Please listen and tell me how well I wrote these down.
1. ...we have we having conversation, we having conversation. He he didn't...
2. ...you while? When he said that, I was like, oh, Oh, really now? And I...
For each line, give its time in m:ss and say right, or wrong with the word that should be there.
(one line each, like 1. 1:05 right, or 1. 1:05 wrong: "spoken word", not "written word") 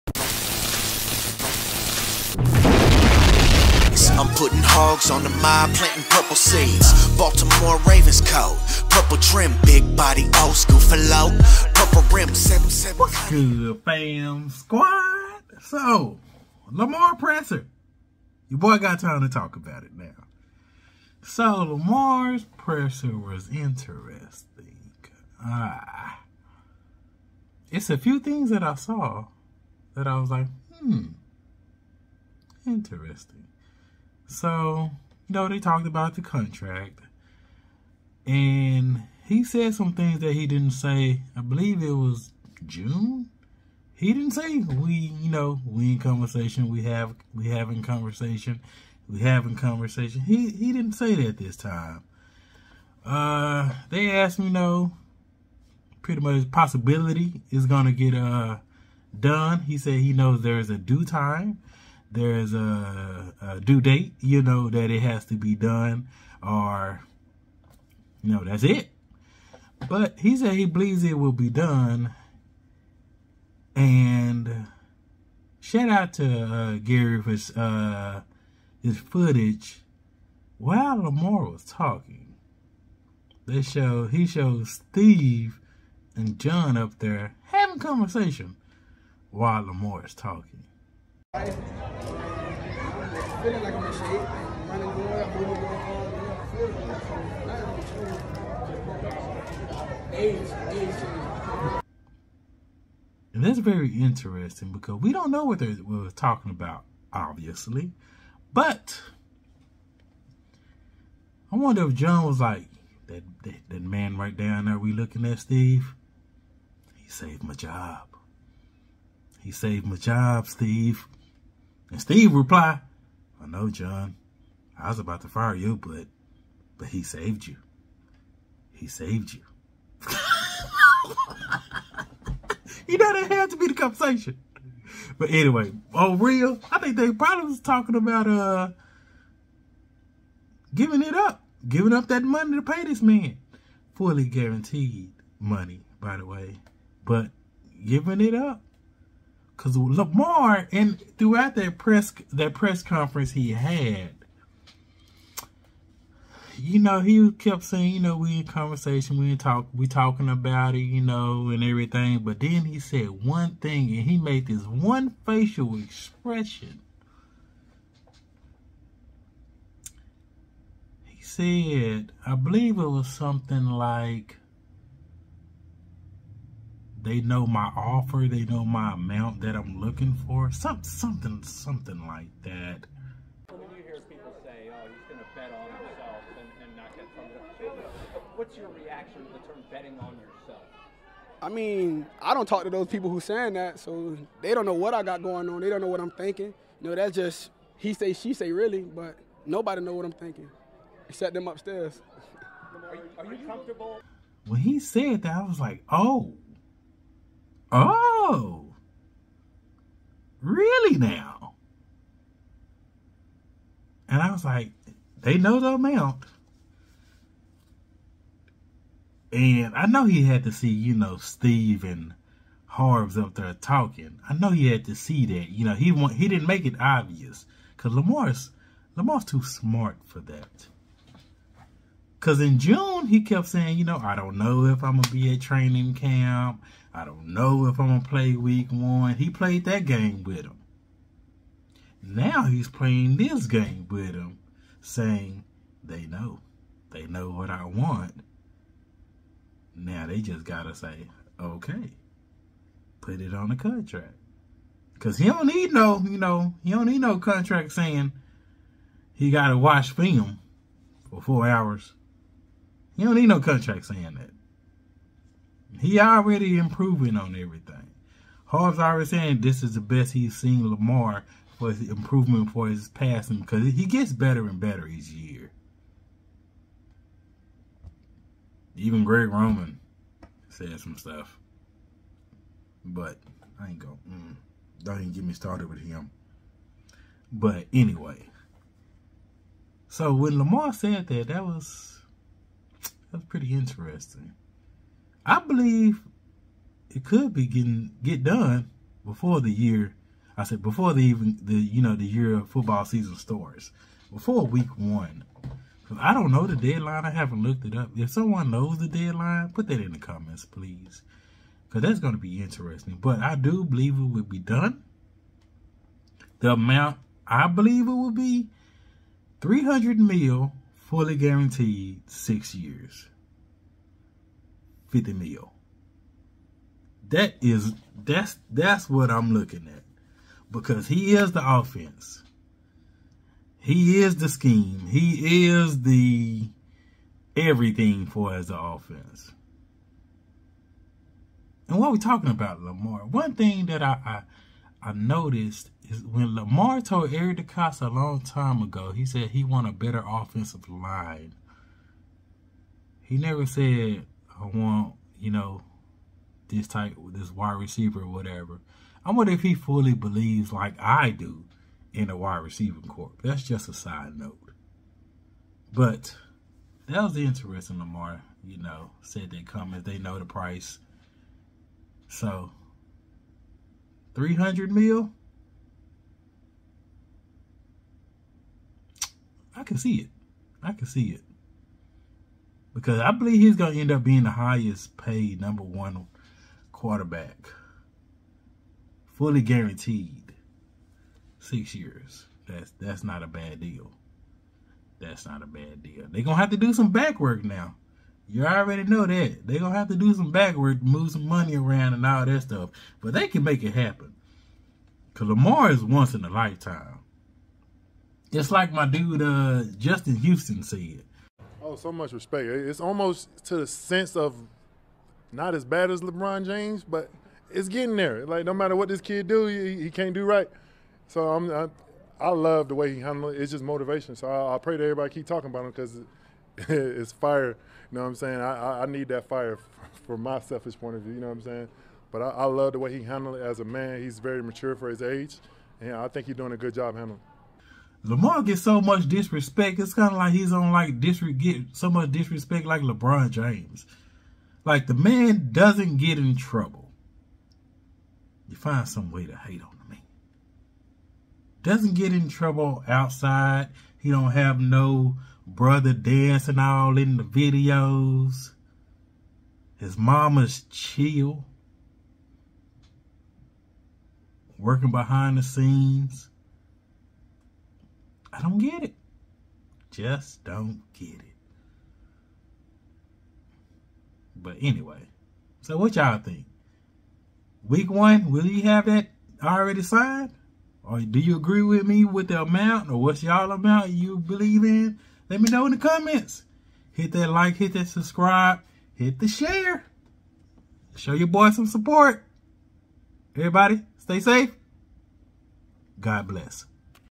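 1. 0:46 right
2. 3:23 wrong: "comfortable", not "while".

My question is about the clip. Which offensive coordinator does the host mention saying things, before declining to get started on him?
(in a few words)
Greg Roman.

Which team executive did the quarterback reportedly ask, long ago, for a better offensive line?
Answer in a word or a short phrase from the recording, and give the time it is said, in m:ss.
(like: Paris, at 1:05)
Eric DeCosta, at 5:47.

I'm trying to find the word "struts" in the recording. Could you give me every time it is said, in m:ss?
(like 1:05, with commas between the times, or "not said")
not said.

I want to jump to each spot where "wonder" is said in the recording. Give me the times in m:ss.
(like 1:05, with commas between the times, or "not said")
1:51, 5:59.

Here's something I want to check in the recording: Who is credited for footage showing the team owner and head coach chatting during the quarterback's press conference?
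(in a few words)
Gary.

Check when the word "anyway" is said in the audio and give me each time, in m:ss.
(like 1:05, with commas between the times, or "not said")
2:15, 4:47, 7:54.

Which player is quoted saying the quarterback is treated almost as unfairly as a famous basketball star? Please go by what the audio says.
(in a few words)
Justin Houston.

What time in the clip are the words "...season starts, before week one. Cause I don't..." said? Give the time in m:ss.
5:02.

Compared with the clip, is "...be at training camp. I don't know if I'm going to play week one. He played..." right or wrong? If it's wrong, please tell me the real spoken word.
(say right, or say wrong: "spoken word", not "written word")
right.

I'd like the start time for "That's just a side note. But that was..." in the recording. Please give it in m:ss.
6:03.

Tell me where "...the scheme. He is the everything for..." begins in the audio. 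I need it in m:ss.
5:34.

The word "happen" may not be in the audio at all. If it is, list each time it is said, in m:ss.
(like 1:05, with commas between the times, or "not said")
6:43.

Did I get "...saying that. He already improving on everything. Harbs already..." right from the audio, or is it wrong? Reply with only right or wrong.
right.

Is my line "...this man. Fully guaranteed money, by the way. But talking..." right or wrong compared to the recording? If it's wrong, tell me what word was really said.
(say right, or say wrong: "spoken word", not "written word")
wrong: "giving", not "talking".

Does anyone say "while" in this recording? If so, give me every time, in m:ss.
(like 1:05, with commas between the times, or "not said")
1:20, 1:29.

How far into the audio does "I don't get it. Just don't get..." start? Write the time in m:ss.
7:48.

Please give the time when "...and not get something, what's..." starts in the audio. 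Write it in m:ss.
3:06.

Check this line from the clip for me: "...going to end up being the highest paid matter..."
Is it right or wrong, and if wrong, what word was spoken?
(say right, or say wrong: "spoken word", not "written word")
wrong: "number", not "matter".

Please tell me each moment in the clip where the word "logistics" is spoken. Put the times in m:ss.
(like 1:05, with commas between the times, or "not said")
not said.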